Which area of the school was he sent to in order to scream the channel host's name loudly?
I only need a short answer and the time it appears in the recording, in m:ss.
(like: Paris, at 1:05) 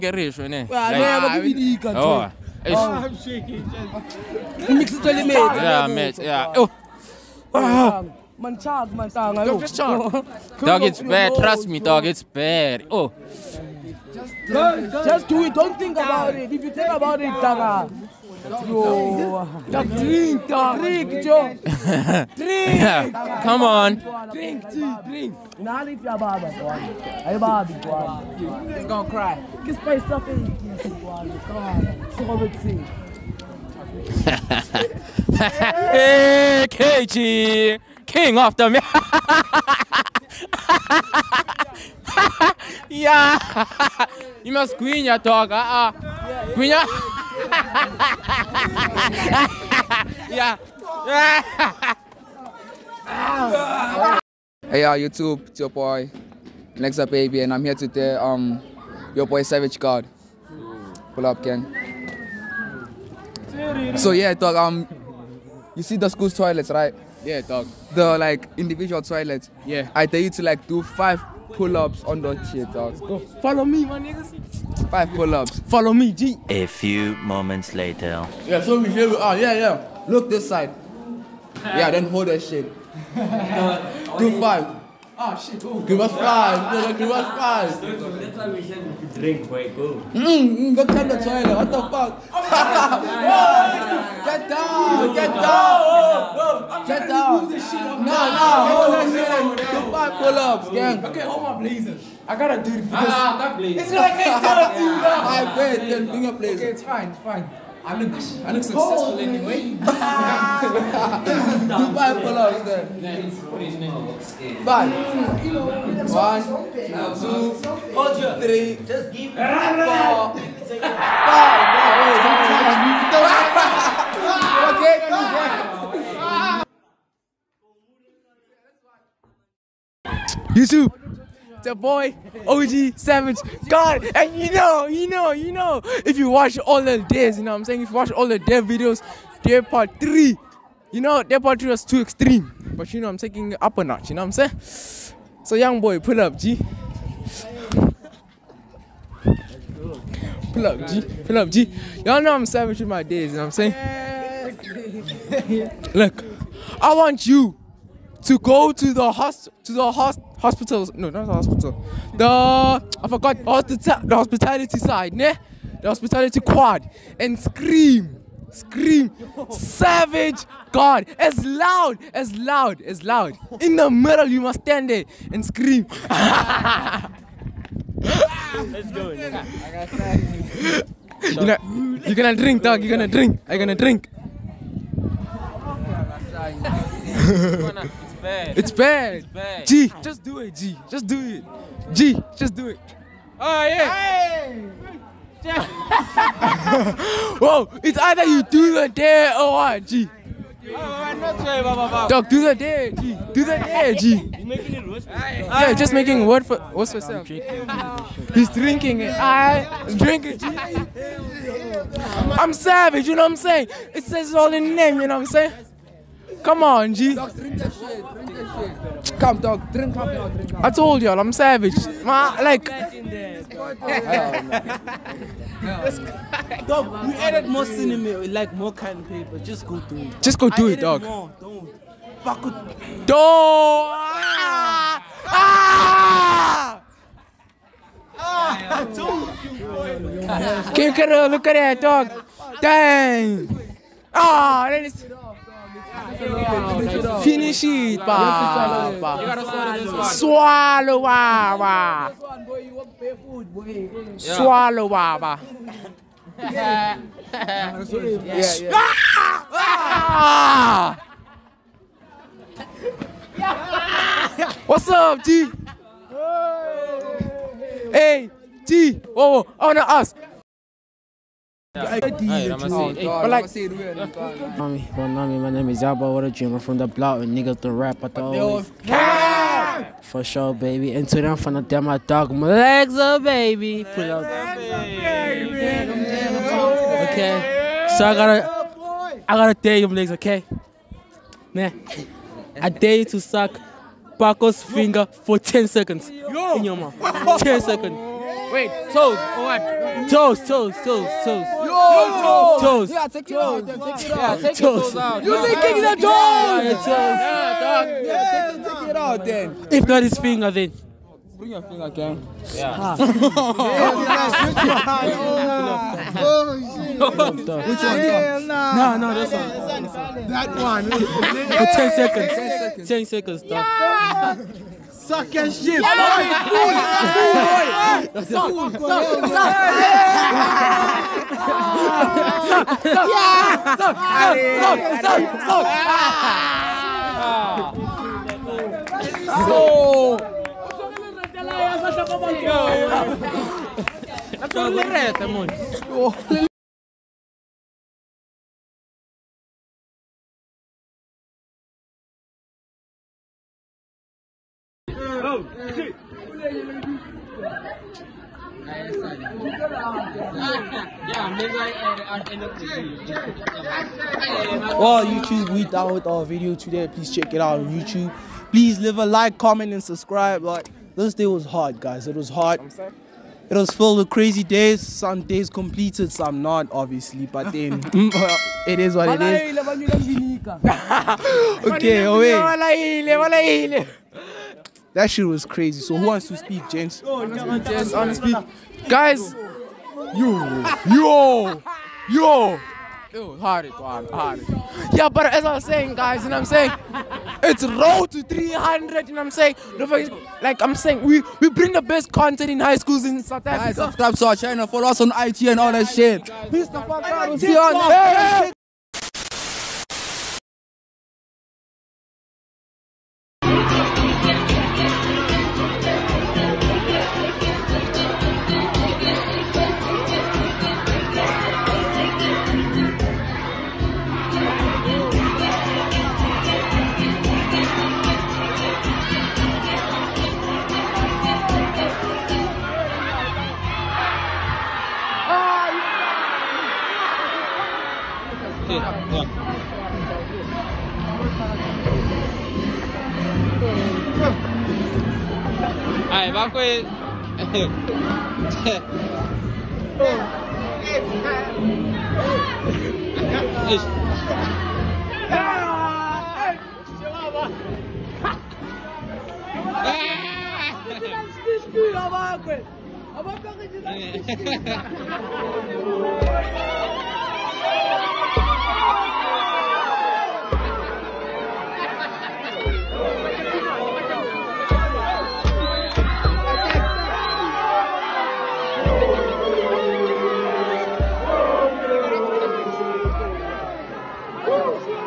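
hospitality quad, at 2:45.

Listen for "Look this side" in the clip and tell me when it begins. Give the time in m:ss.
1:20.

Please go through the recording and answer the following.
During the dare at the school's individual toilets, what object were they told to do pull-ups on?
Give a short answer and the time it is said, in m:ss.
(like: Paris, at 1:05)
chair, at 1:12.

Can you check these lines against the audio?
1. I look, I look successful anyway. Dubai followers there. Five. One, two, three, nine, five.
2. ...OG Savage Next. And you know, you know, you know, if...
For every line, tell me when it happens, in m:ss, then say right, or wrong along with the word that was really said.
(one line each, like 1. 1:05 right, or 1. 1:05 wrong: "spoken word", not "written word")
1. 1:47 wrong: "four", not "nine"
2. 2:12 wrong: "God", not "Next".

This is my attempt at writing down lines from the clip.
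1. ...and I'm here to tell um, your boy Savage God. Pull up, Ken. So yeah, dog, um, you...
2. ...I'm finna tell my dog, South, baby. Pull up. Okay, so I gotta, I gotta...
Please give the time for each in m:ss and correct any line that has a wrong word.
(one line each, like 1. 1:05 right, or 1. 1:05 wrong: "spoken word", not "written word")
1. 0:57 right
2. 4:41 wrong: "Malexa", not "South".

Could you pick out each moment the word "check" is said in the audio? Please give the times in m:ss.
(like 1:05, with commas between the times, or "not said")
1:30, 6:07.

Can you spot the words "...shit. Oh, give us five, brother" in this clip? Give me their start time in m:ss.
1:25.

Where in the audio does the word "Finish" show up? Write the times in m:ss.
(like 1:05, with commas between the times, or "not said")
4:07.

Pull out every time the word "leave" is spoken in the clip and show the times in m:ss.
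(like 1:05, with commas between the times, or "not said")
0:25, 6:08.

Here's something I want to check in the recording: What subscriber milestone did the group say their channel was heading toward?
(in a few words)
300.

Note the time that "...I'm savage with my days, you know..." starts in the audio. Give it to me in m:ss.
2:32.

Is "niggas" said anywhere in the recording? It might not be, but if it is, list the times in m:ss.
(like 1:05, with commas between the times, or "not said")
1:13, 4:37.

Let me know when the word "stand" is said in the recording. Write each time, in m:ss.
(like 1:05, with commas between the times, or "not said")
2:54.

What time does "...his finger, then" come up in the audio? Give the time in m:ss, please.
5:10.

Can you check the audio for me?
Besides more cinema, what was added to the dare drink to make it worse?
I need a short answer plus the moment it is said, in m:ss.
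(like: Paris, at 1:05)
cotton paper, at 3:48.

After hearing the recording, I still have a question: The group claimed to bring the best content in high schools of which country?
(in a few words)
South Africa.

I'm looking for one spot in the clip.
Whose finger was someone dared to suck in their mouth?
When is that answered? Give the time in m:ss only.
4:54.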